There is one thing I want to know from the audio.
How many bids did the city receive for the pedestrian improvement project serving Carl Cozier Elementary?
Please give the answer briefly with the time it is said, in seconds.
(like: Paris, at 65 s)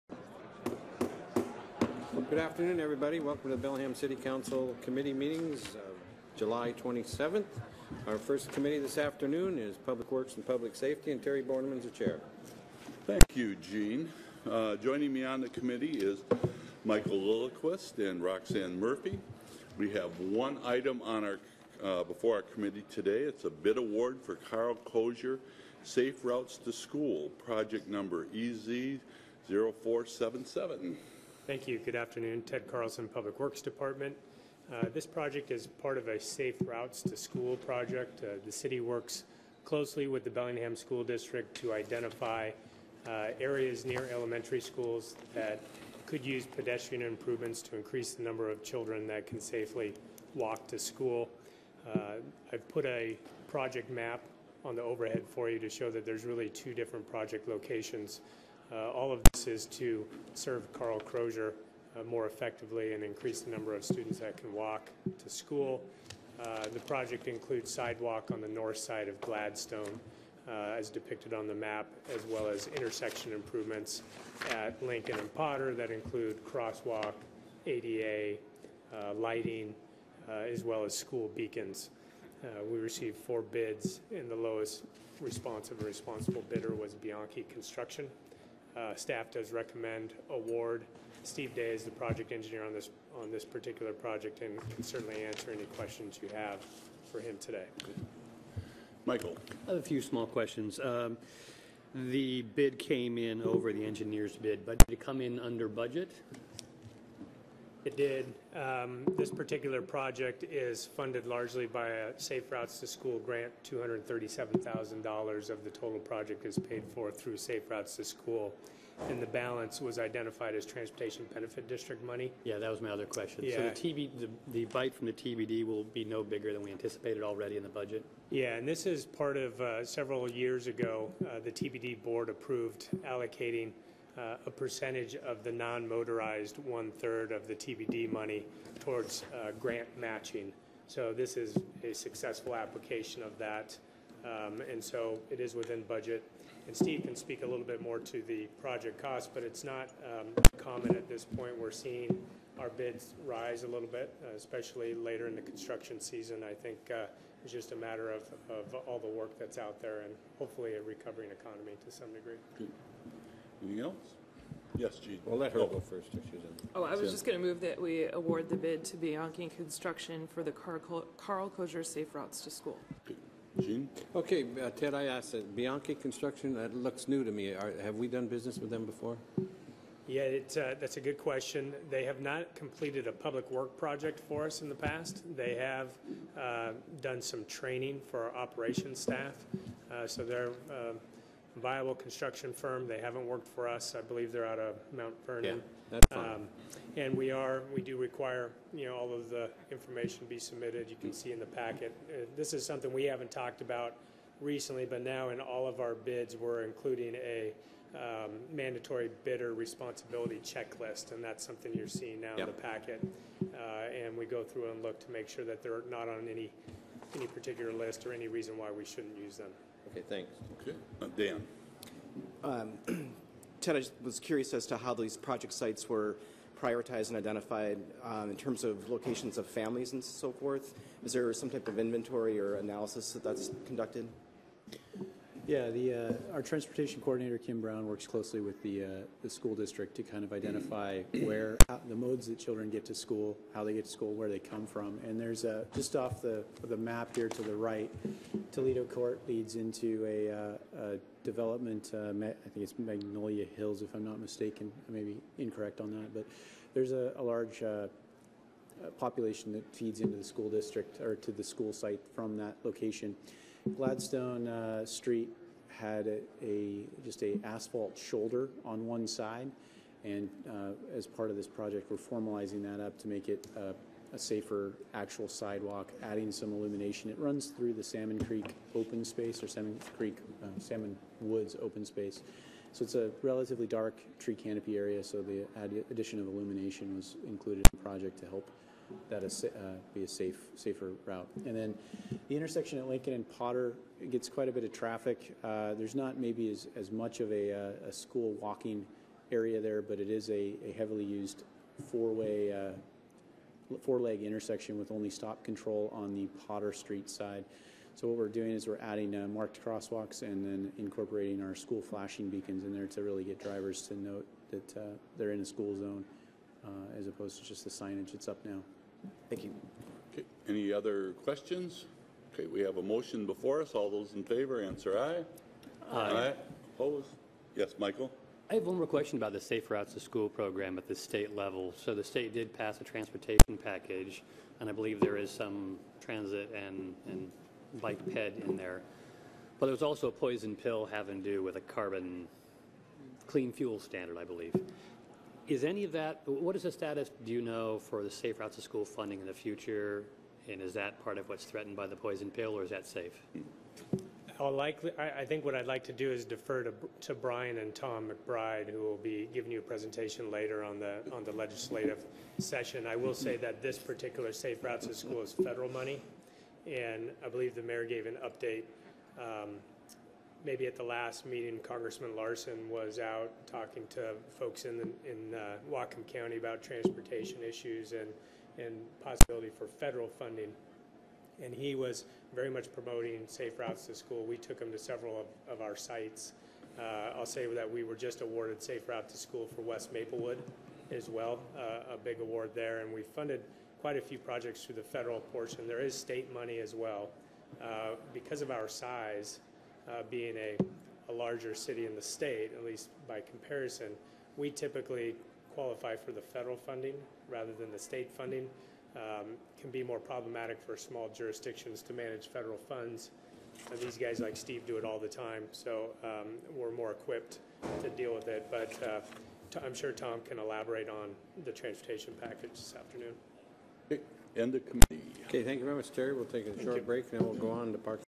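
4, at 83 s.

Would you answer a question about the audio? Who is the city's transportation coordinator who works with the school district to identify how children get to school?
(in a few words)
Kim Brown.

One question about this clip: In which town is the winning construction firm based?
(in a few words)
Mount Vernon.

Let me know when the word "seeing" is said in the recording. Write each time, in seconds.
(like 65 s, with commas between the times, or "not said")
151 s, 211 s.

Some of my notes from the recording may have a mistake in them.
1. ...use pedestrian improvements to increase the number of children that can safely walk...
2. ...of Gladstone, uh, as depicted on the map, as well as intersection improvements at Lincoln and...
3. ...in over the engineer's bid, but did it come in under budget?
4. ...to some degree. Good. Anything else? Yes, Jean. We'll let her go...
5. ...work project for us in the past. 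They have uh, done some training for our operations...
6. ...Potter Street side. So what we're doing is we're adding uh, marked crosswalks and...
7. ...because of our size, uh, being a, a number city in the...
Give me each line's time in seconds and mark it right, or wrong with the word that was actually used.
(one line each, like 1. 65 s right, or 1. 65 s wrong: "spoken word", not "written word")
1. 46 s right
2. 69 s right
3. 103 s right
4. 161 s right
5. 183 s right
6. 306 s right
7. 398 s wrong: "larger", not "number".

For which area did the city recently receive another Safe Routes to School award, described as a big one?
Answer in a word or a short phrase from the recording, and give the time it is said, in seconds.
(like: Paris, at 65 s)
West Maplewood, at 389 s.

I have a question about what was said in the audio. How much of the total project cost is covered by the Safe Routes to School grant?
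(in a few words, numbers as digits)
$237,000.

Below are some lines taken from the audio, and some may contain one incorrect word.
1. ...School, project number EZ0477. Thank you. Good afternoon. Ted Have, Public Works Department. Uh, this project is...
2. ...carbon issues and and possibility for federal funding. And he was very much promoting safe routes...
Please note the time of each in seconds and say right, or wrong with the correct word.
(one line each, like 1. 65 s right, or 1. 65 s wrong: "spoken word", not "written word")
1. 26 s wrong: "Carlson", not "Have"
2. 376 s wrong: "transportation", not "carbon".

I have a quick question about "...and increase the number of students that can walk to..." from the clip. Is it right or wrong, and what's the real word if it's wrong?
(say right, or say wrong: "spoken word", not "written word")
right.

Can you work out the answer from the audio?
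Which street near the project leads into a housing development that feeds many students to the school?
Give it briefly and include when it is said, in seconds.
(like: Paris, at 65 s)
Toledo Court, at 248 s.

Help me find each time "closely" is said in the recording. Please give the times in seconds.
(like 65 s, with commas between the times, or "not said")
39 s, 238 s.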